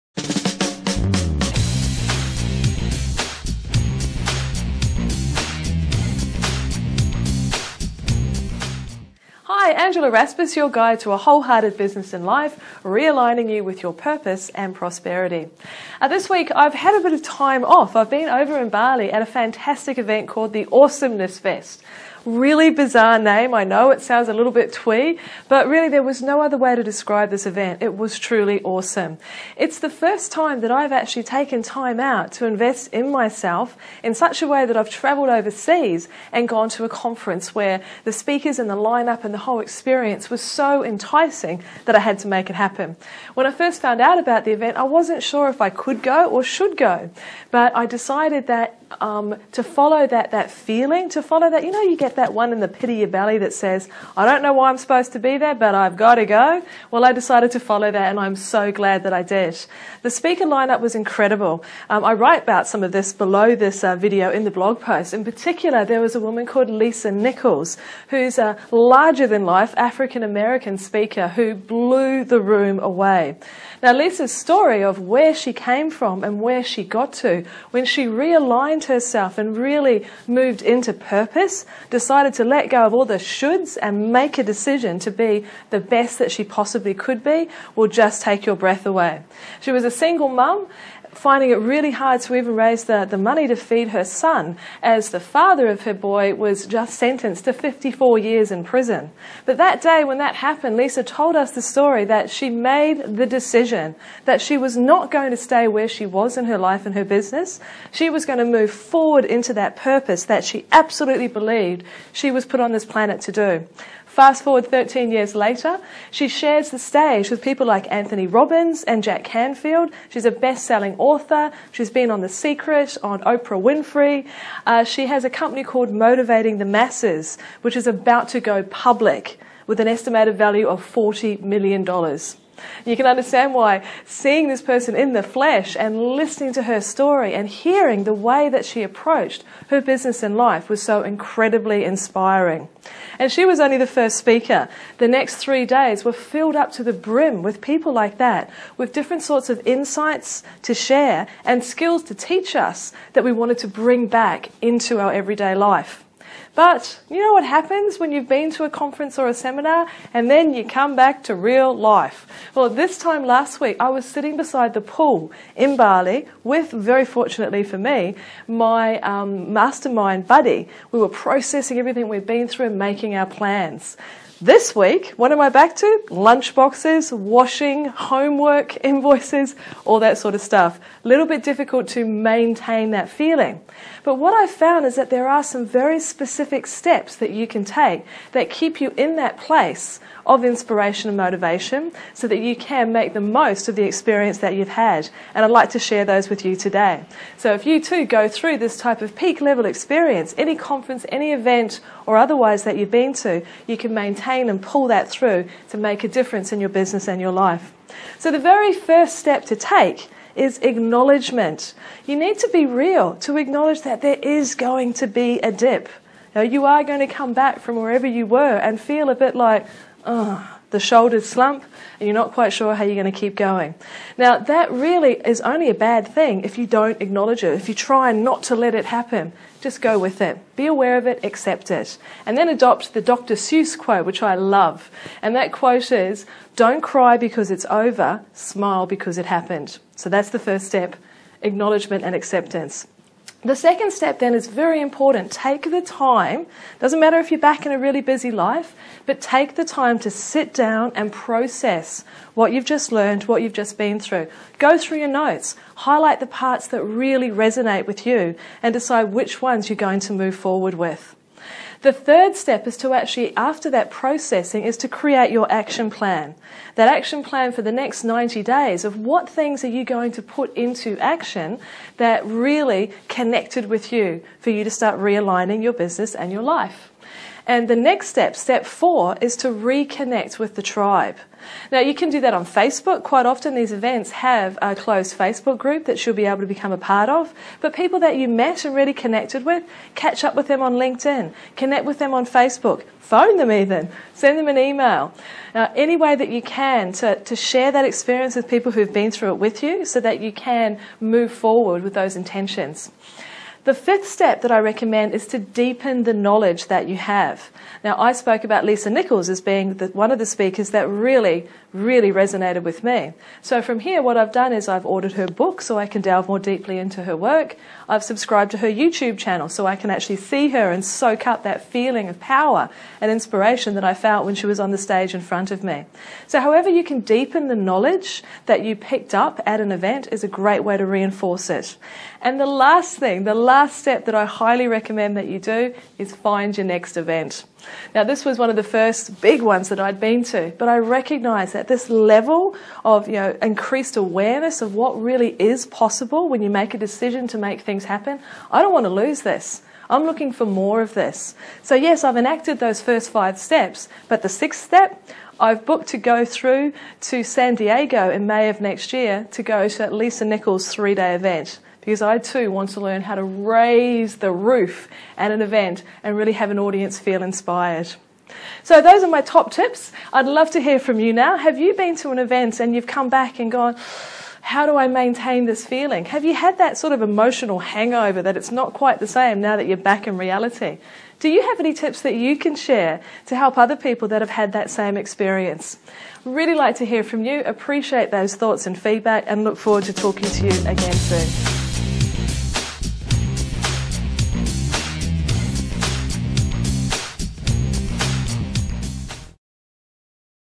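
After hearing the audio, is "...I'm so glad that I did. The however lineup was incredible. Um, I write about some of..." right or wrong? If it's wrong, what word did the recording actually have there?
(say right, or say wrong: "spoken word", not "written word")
wrong: "speaker", not "however".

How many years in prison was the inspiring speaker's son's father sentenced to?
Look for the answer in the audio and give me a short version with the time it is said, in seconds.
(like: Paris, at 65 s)
54, at 97 s.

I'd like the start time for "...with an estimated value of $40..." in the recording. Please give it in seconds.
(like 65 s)
129 s.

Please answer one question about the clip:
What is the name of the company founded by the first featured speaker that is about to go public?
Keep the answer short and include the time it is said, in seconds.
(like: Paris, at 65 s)
Motivating the Masses, at 125 s.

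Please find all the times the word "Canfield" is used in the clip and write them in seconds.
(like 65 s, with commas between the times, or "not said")
119 s.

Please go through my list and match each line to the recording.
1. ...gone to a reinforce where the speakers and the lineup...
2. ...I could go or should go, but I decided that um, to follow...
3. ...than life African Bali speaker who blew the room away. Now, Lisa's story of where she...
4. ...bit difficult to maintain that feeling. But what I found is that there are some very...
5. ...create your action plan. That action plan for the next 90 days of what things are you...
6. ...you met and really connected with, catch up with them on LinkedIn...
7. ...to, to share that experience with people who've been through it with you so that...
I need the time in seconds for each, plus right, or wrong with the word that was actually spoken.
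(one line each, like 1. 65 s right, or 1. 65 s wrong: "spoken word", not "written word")
1. 36 s wrong: "conference", not "reinforce"
2. 45 s right
3. 69 s wrong: "American", not "Bali"
4. 181 s right
5. 264 s right
6. 288 s right
7. 296 s right.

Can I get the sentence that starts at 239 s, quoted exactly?
So that's the first step acknowledgement and acceptance.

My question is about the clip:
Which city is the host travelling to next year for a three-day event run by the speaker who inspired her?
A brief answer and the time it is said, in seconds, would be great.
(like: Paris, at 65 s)
San Diego, at 357 s.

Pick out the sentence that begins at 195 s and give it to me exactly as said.
And I'd like to share those with you today.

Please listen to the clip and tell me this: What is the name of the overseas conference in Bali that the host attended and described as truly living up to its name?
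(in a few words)
Awesomeness Fest.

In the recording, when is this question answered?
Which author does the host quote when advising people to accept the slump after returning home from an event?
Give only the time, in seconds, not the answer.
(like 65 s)
233 s.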